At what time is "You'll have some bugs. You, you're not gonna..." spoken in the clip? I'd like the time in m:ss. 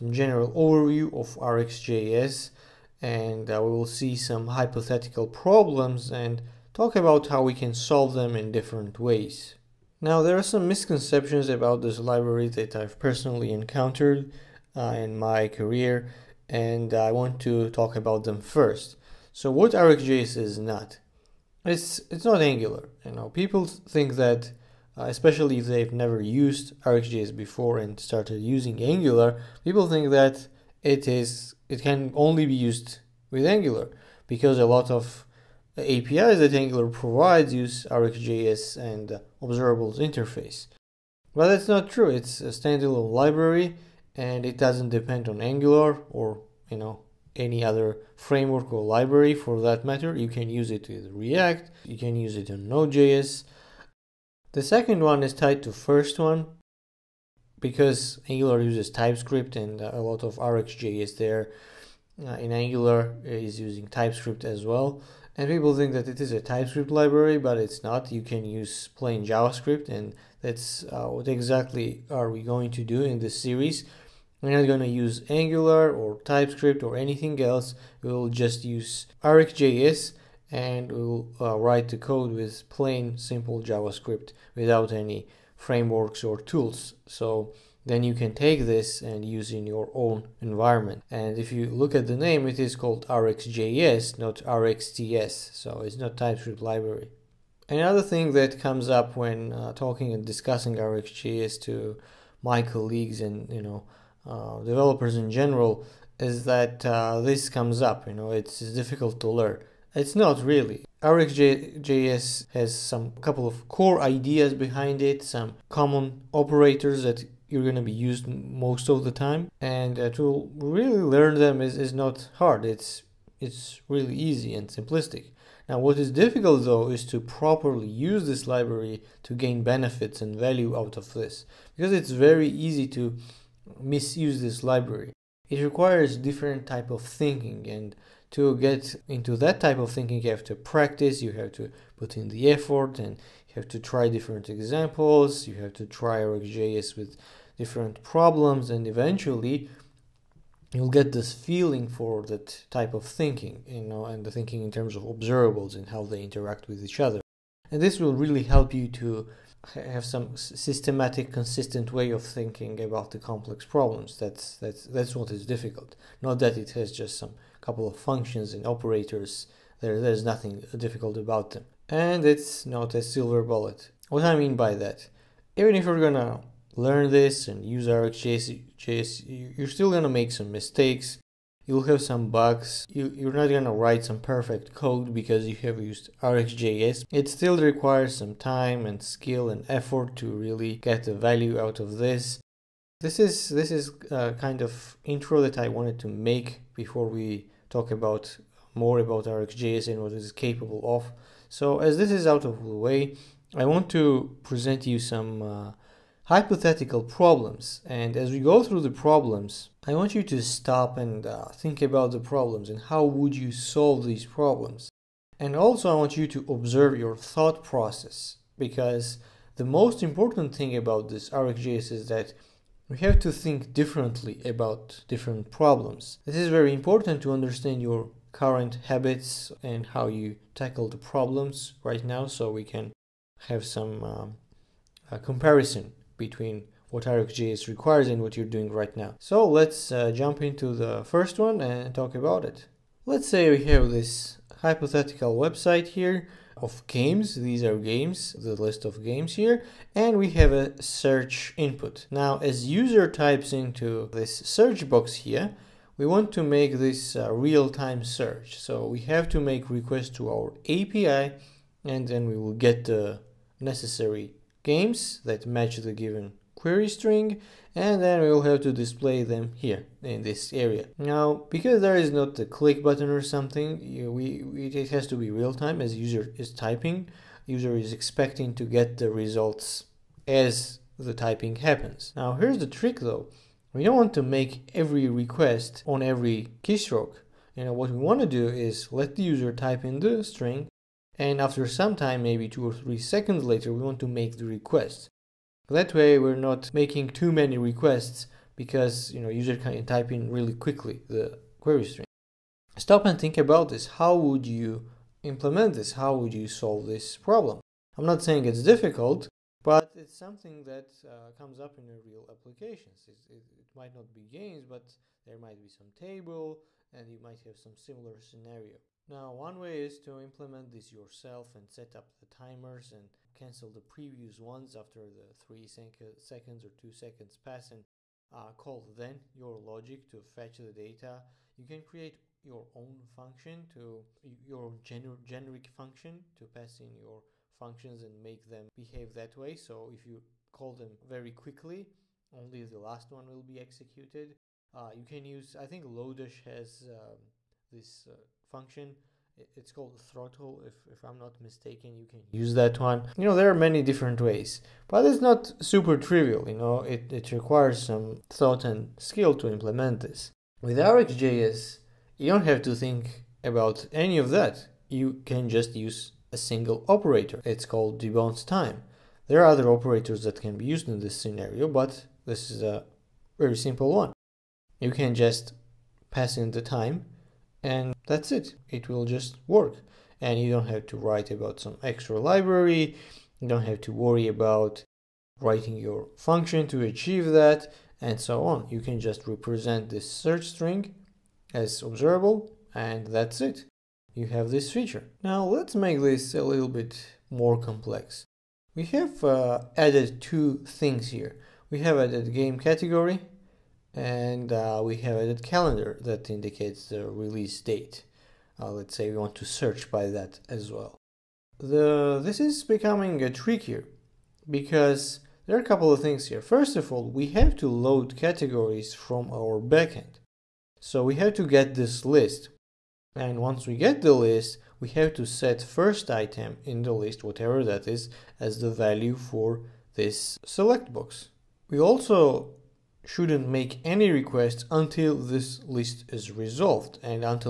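3:01.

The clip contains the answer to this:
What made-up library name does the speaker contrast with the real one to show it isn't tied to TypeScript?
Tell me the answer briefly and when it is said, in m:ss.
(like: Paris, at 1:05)
RxTS, at 1:34.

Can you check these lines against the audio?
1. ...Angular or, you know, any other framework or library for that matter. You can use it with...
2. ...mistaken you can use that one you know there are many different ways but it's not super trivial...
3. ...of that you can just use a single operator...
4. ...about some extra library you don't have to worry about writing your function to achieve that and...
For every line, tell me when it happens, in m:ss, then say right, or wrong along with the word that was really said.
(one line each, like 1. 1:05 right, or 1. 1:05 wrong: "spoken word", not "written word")
1. 0:45 right
2. 5:51 right
3. 6:04 right
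4. 6:21 right.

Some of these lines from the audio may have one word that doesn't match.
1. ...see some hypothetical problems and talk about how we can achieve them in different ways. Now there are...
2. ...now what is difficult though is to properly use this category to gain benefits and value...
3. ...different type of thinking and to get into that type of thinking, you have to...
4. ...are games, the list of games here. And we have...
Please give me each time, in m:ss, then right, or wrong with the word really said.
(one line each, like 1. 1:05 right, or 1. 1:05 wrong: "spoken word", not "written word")
1. 0:03 wrong: "solve", not "achieve"
2. 2:05 wrong: "library", not "category"
3. 2:16 right
4. 4:07 right.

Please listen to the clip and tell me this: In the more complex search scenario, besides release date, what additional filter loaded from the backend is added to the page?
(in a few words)
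game category.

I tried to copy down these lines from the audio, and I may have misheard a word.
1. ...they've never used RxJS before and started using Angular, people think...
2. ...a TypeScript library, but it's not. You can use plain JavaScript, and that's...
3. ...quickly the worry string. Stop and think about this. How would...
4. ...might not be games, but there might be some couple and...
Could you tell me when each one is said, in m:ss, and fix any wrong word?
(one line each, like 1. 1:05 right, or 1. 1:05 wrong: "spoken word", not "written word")
1. 0:25 right
2. 1:06 right
3. 5:00 wrong: "query", not "worry"
4. 5:13 wrong: "table", not "couple".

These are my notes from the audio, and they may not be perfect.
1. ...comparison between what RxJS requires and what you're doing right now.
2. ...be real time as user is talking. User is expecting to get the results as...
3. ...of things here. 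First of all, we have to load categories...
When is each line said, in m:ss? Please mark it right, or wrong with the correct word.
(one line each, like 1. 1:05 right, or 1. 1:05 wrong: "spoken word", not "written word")
1. 3:55 right
2. 4:35 wrong: "typing", not "talking"
3. 6:55 right.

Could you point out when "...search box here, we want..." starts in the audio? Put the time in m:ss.
4:14.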